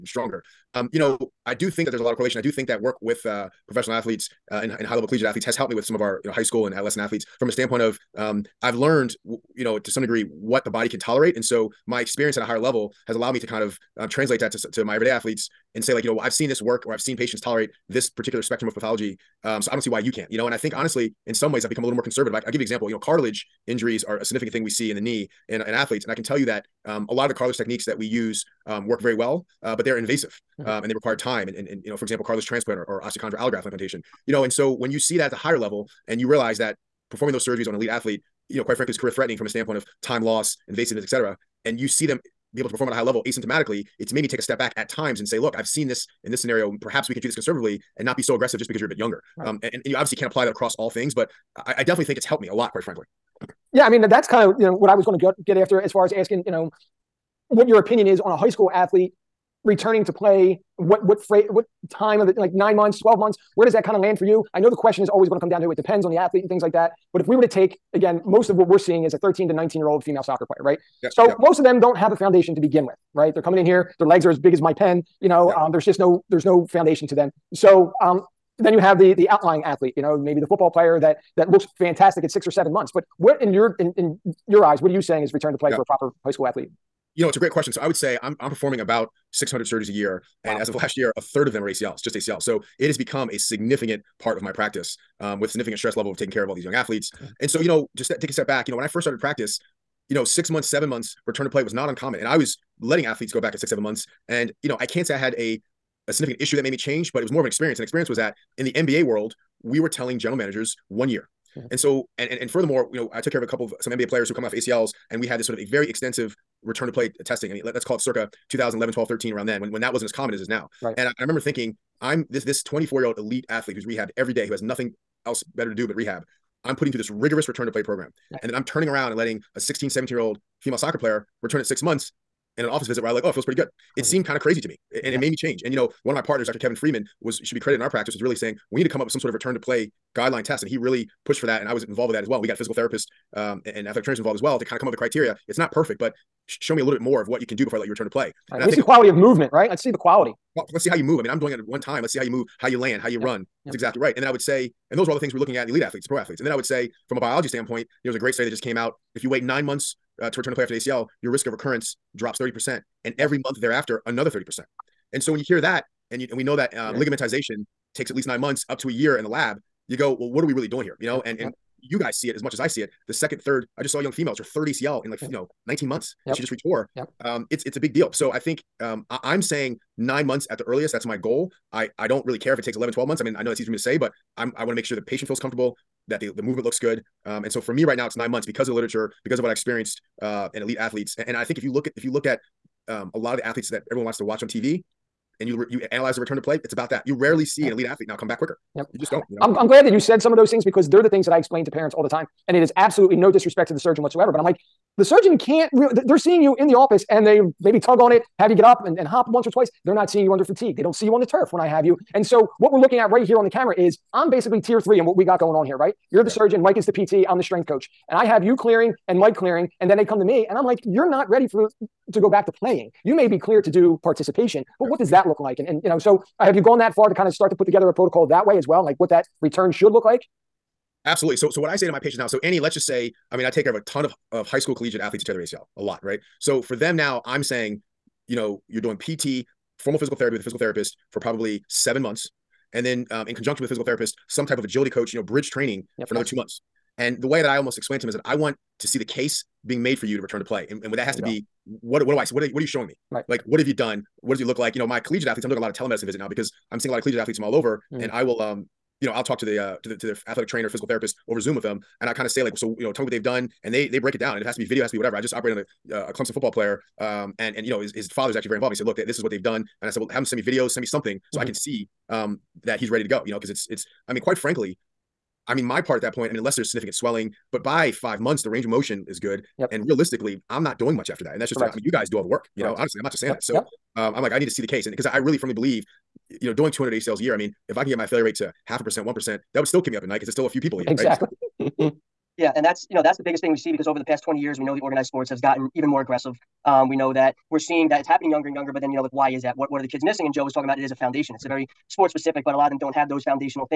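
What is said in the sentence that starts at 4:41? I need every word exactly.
I mean, you guys do all the work, you Correct.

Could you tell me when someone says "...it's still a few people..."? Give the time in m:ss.
4:50.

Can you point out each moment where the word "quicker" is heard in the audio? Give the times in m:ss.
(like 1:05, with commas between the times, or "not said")
3:18.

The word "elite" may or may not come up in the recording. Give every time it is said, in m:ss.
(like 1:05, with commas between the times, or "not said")
0:37, 2:03, 2:35, 3:10, 3:17.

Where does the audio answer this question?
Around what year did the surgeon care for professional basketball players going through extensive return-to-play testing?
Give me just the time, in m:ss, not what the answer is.
1:58.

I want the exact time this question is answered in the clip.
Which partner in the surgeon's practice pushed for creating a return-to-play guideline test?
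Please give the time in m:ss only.
2:16.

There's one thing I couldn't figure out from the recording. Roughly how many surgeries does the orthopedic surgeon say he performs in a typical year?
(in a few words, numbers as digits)
600.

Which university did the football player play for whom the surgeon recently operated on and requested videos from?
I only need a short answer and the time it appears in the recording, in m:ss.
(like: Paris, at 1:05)
Clemson, at 4:26.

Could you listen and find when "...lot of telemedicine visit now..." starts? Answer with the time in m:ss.
4:15.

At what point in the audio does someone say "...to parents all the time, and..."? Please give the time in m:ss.
3:21.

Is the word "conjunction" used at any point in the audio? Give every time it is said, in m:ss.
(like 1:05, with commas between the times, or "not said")
4:03.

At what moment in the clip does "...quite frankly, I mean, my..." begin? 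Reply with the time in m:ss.
4:34.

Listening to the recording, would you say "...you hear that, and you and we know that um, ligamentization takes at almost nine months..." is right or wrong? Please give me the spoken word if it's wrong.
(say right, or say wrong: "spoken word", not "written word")
wrong: "least", not "almost".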